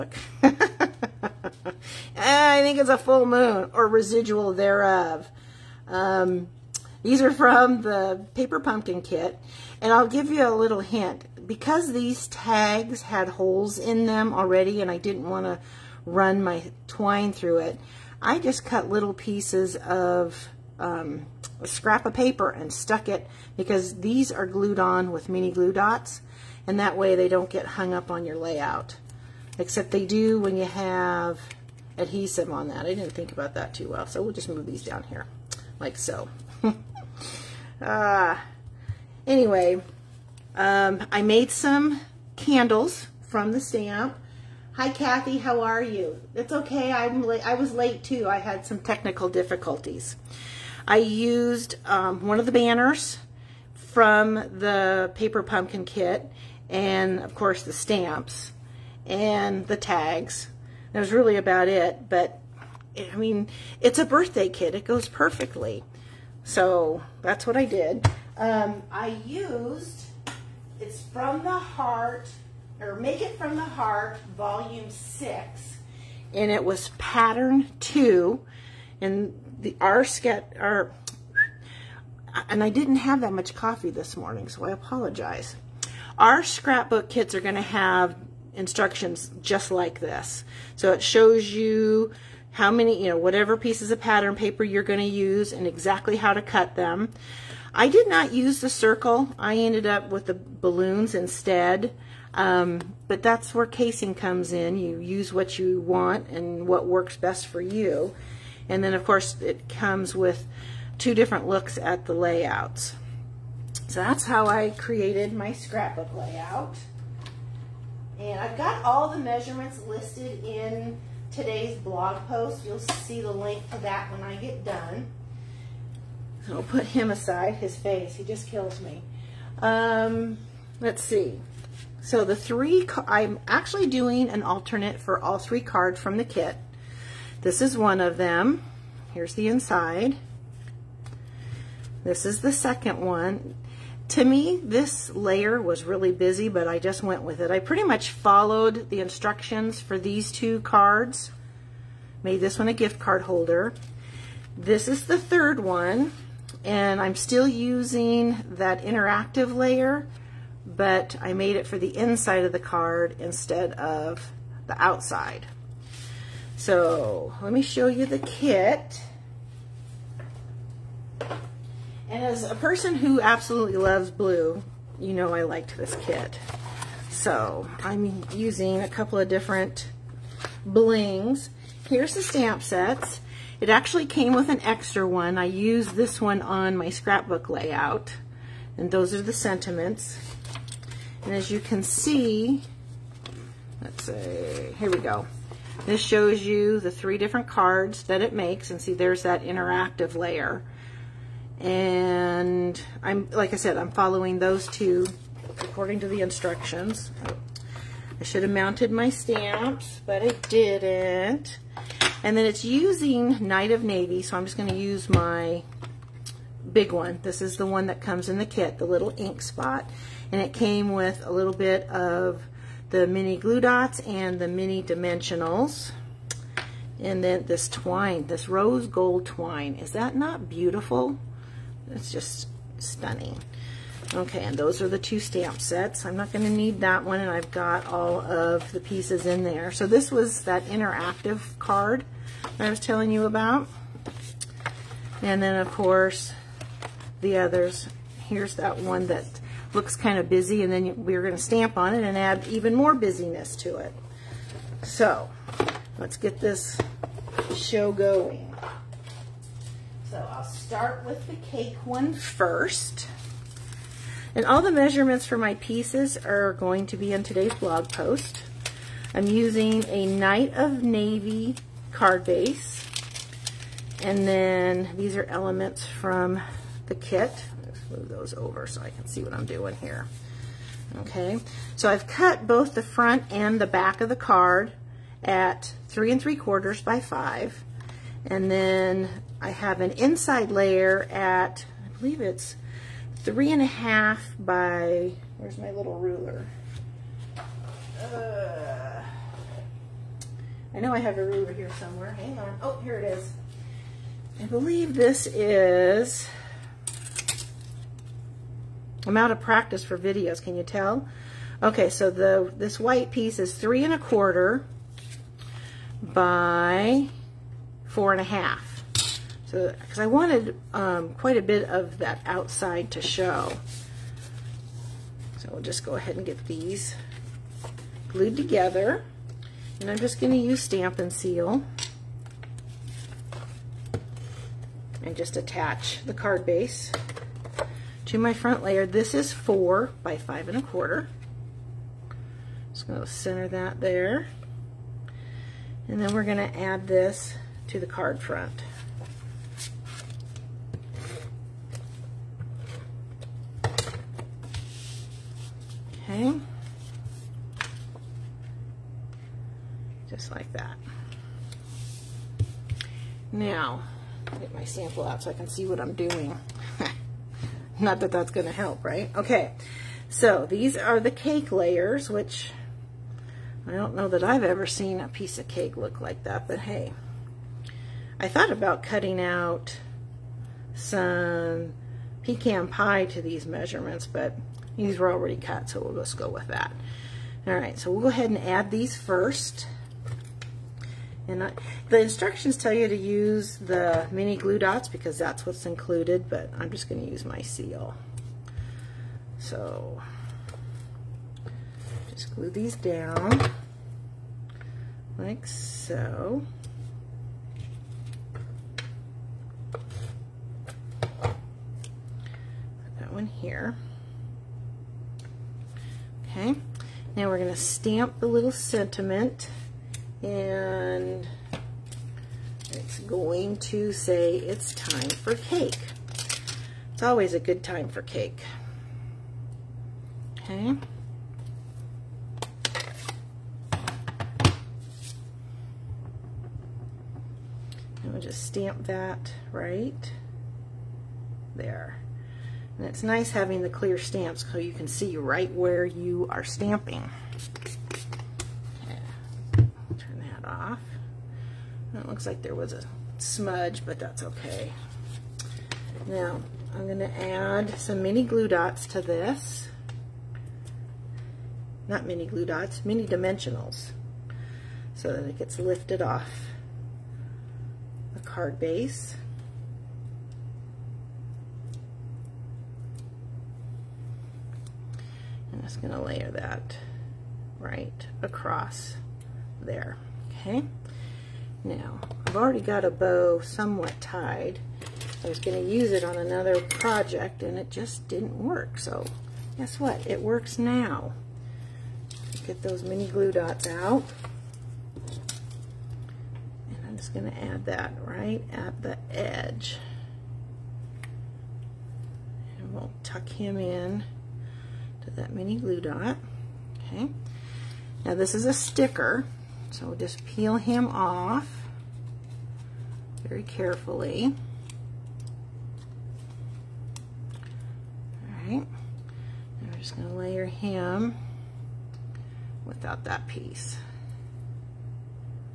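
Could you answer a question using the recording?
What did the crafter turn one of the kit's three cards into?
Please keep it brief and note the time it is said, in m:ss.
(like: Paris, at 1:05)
gift card holder, at 2:32.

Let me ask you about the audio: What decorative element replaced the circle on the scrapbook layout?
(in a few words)
balloons.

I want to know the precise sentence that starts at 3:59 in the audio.
So this was that interactive card that I was telling you about.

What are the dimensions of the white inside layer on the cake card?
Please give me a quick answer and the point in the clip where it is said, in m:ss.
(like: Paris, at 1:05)
3 1/4 by 4 1/2, at 5:13.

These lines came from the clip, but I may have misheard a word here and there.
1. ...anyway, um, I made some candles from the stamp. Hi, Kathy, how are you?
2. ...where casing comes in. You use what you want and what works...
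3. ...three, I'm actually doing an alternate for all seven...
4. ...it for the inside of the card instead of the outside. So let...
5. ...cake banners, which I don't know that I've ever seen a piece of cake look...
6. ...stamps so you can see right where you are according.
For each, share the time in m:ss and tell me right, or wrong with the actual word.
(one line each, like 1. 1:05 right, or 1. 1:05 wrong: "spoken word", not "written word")
1. 0:39 right
2. 1:43 right
3. 2:12 wrong: "three", not "seven"
4. 2:41 right
5. 6:11 wrong: "layers", not "banners"
6. 7:23 wrong: "stamping", not "according".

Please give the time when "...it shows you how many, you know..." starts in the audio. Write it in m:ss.
1:30.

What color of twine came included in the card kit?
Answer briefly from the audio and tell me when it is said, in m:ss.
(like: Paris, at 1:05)
rose gold, at 3:48.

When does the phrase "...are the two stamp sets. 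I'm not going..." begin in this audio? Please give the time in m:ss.
3:54.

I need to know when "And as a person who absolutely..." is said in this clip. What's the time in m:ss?
2:52.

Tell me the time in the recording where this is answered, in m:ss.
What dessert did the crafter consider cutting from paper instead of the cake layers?
6:22.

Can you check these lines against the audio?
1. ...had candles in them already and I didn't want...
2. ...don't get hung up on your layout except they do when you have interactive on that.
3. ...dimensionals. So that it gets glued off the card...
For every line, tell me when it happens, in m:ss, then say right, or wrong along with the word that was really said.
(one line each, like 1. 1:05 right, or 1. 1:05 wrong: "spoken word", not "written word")
1. 0:13 wrong: "holes", not "candles"
2. 0:27 wrong: "adhesive", not "interactive"
3. 7:43 wrong: "lifted", not "glued".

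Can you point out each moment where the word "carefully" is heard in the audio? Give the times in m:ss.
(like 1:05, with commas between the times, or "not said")
8:33.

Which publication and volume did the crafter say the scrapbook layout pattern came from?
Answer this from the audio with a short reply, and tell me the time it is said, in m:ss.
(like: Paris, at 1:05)
Make It From the Heart, Volume 6, at 1:12.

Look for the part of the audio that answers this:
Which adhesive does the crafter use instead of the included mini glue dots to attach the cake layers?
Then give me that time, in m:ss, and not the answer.
5:30.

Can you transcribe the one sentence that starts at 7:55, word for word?
just gonna layer that right across there, okay?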